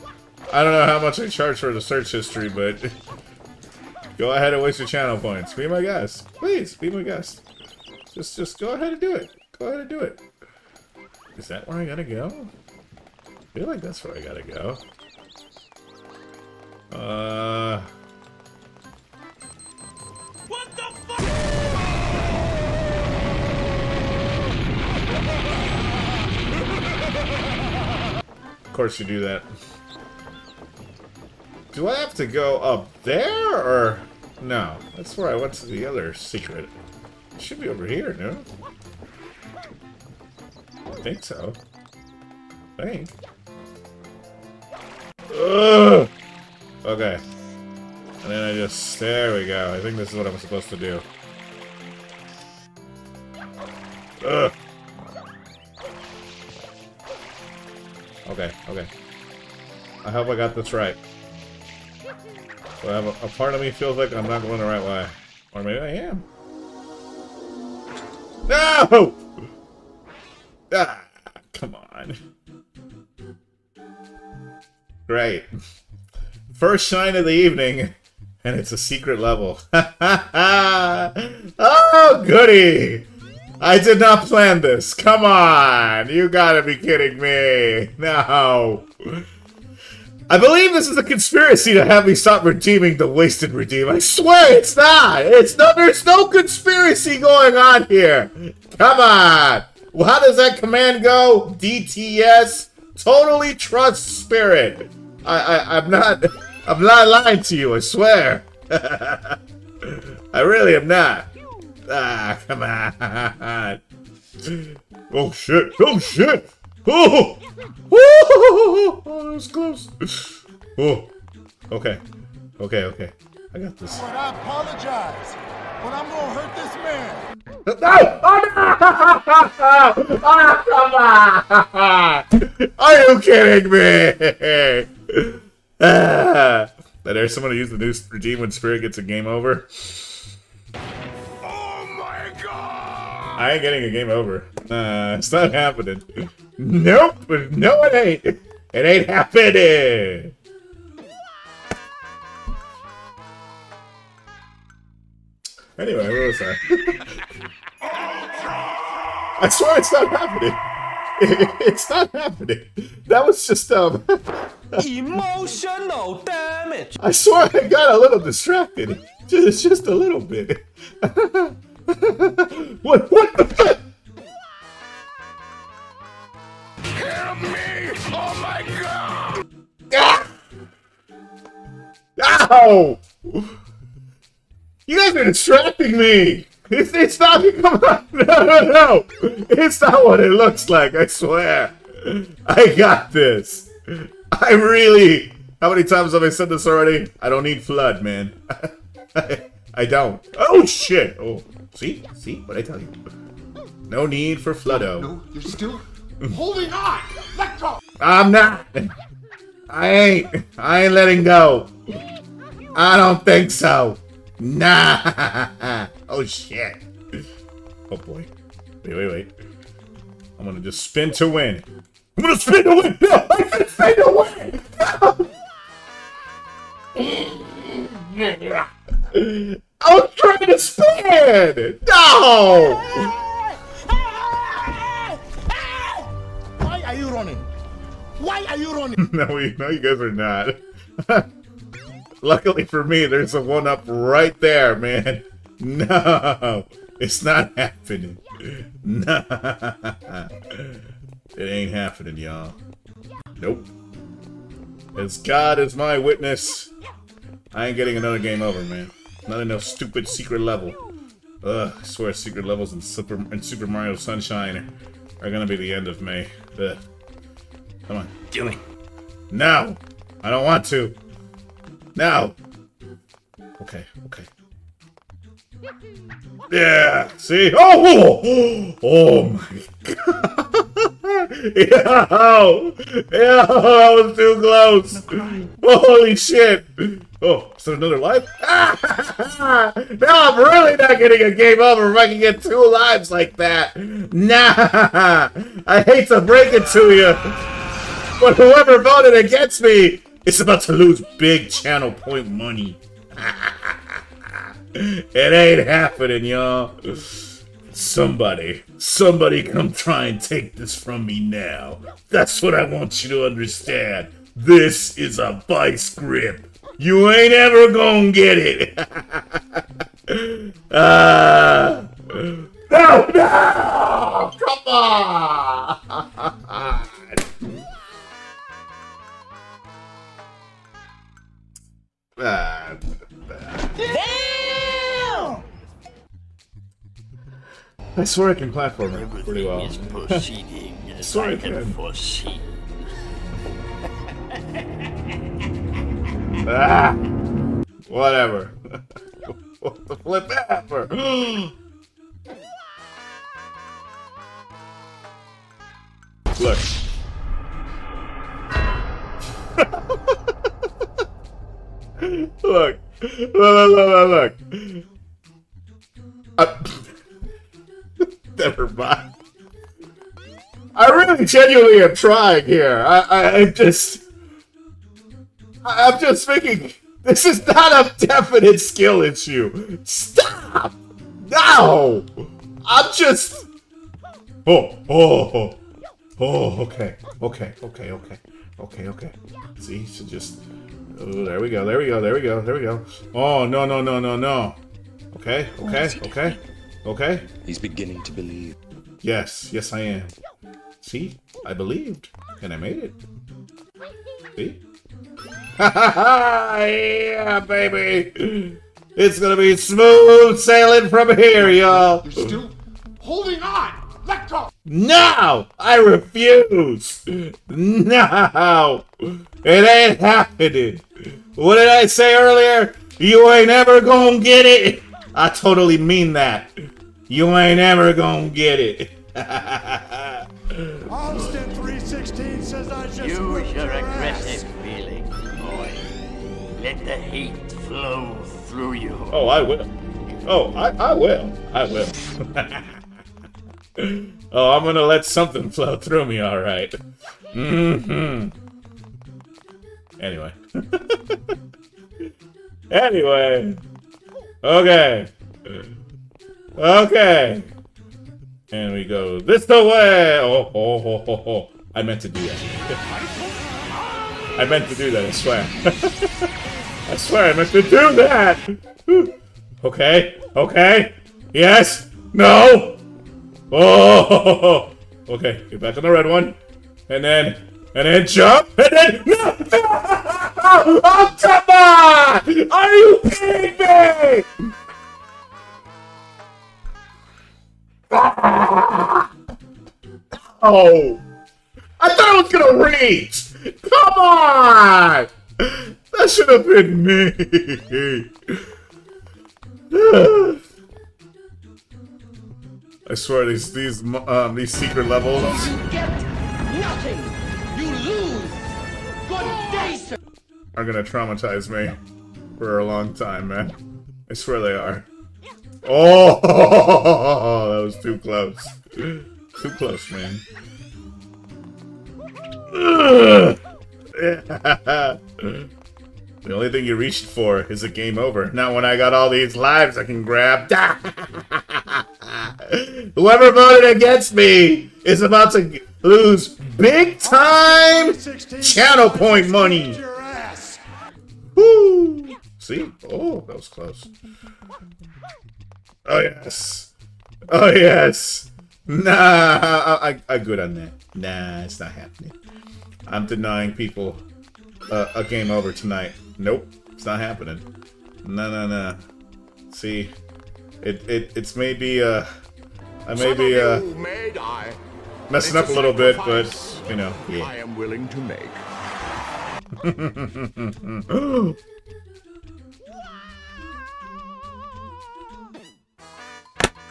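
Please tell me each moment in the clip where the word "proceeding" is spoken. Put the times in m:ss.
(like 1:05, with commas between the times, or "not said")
5:39.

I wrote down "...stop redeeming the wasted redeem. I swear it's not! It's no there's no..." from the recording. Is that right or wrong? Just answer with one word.
right.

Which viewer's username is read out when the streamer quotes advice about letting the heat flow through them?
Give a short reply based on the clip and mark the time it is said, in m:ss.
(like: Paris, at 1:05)
Austin 316, at 7:09.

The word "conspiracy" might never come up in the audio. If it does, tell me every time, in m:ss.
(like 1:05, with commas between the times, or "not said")
1:31, 1:36.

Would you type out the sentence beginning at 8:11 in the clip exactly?
I thought I was gonna reach!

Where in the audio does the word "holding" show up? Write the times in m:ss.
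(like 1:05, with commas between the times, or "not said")
3:26, 6:53.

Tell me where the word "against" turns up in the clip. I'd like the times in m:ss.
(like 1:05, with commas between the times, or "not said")
4:59, 8:53.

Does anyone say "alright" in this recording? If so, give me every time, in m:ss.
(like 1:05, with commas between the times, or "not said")
7:26.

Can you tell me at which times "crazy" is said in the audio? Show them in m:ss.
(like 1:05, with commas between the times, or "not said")
not said.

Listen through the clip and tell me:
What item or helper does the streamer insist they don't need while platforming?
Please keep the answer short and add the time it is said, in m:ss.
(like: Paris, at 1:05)
FLUDD, at 3:17.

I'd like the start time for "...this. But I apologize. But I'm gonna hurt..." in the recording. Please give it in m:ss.
2:03.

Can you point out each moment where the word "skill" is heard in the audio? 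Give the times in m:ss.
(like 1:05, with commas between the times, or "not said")
6:18.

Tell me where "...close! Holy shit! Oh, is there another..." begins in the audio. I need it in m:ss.
4:44.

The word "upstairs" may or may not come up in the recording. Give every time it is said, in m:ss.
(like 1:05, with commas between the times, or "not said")
not said.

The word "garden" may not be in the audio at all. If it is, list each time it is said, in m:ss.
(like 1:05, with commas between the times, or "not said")
not said.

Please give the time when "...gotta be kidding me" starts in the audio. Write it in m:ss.
1:26.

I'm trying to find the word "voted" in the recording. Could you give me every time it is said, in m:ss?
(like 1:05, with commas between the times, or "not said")
4:58, 8:53.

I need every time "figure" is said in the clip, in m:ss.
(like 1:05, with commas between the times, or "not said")
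not said.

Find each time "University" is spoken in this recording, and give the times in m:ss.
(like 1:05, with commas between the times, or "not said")
not said.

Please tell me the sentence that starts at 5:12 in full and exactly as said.
That's what I want you to understand.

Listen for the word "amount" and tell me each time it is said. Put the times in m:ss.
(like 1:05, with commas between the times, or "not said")
not said.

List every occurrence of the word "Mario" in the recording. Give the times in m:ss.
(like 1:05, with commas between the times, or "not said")
4:23.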